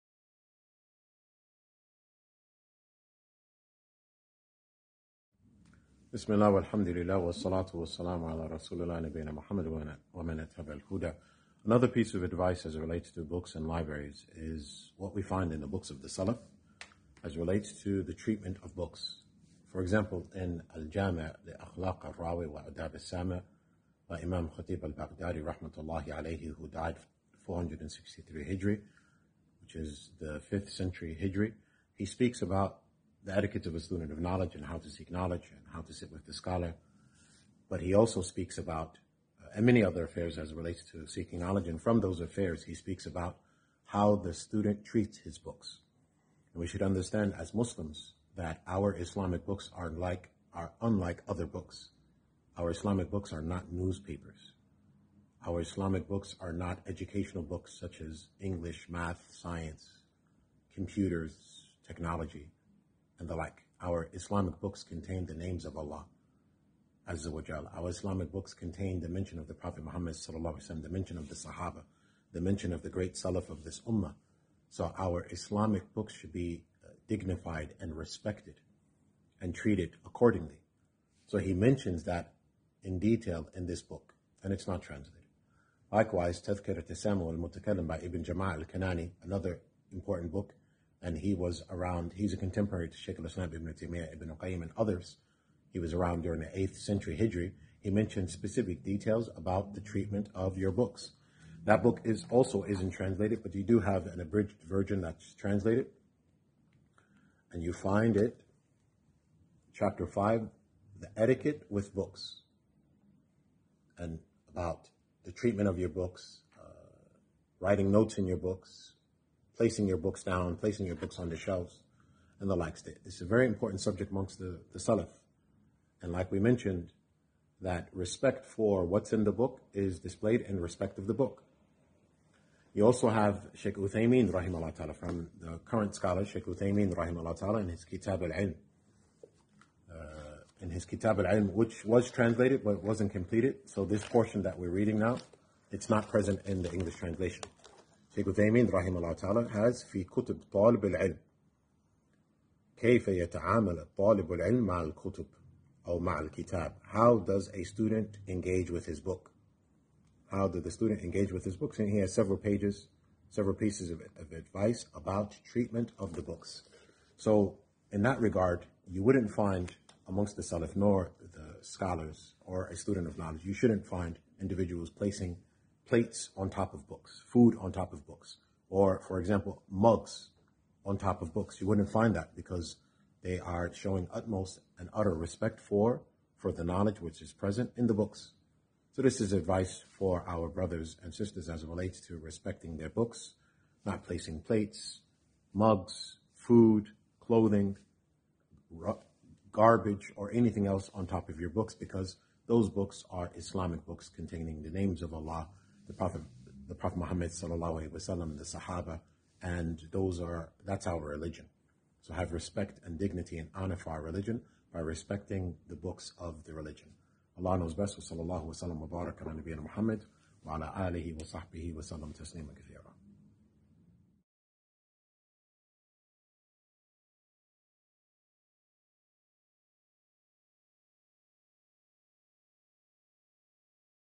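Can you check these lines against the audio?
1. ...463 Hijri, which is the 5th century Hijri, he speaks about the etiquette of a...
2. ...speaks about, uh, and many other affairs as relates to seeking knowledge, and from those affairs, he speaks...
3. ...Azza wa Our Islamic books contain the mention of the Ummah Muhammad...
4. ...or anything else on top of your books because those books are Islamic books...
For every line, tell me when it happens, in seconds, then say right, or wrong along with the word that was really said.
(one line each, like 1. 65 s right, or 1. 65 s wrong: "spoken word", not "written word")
1. 27 s right
2. 38 s right
3. 67 s wrong: "Prophet", not "Ummah"
4. 200 s right.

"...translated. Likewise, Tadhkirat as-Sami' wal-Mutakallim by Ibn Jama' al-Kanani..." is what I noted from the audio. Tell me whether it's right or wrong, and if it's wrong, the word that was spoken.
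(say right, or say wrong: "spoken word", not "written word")
right.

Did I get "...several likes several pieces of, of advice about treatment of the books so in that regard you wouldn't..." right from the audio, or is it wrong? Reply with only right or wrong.
wrong.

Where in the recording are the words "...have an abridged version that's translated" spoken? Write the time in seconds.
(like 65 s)
103 s.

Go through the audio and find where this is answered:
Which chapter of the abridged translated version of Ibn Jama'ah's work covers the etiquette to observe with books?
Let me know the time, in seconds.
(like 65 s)
109 s.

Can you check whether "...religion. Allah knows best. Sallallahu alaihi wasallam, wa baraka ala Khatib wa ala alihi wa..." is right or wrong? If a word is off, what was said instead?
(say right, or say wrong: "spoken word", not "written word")
wrong: "Muhammad", not "Khatib".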